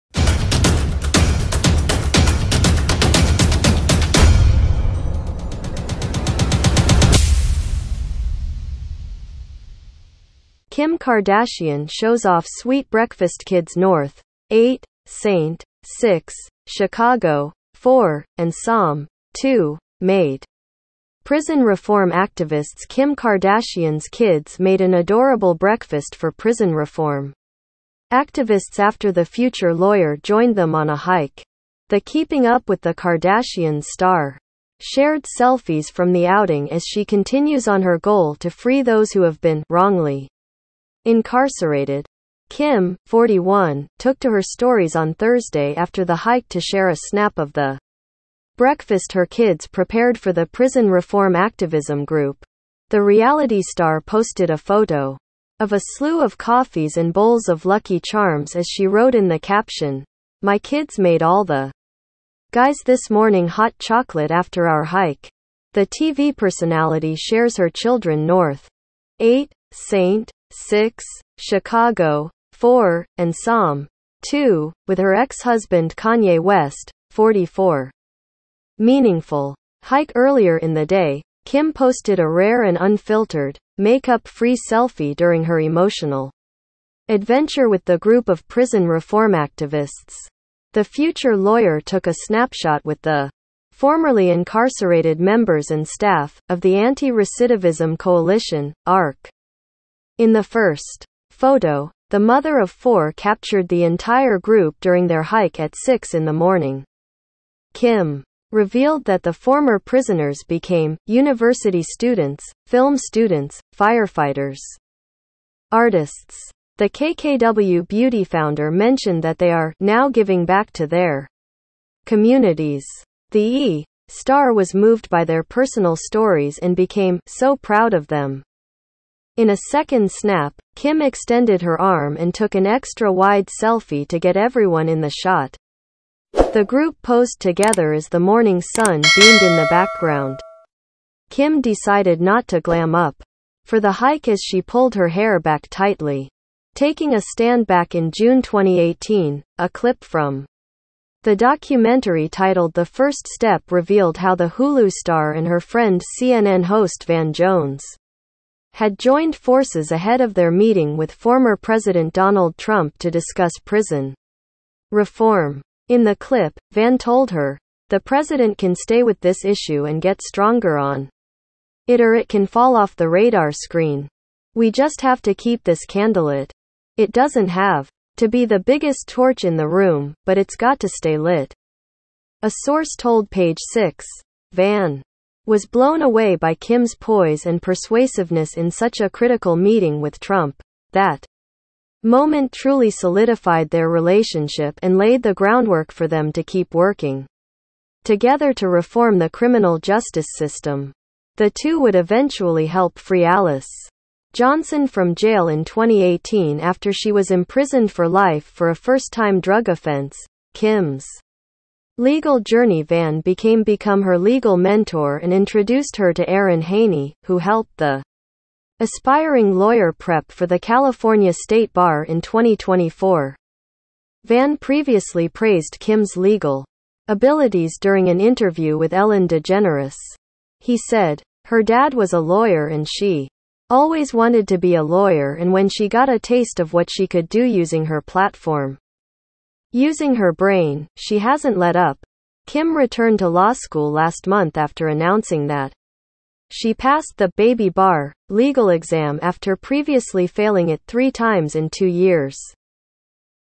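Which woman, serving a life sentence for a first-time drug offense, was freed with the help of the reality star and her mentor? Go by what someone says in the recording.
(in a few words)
Alice Johnson.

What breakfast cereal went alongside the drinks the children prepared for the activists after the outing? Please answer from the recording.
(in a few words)
Lucky Charms.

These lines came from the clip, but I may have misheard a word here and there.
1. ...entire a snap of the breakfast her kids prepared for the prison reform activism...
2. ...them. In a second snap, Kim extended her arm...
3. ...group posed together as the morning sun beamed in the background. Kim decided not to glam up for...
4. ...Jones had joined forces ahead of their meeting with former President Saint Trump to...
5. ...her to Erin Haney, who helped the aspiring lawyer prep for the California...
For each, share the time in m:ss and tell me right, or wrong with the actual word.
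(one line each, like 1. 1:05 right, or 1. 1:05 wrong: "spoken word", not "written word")
1. 0:46 wrong: "share", not "entire"
2. 2:08 right
3. 2:16 right
4. 2:37 wrong: "Donald", not "Saint"
5. 3:35 right.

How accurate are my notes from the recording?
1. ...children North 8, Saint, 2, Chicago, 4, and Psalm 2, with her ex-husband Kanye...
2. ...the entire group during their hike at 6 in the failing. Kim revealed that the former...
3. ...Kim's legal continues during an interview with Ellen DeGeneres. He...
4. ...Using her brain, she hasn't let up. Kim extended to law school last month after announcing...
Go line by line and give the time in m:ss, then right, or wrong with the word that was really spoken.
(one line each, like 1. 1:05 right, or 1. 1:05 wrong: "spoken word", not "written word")
1. 1:07 wrong: "6", not "2"
2. 1:43 wrong: "morning", not "failing"
3. 3:45 wrong: "abilities", not "continues"
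4. 3:59 wrong: "returned", not "extended".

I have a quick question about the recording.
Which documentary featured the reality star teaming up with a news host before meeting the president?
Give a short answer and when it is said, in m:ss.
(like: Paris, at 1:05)
The First Step, at 2:32.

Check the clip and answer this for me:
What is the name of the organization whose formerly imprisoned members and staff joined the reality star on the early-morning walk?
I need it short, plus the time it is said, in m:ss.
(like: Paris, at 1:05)
Anti Recidivism Coalition, at 1:36.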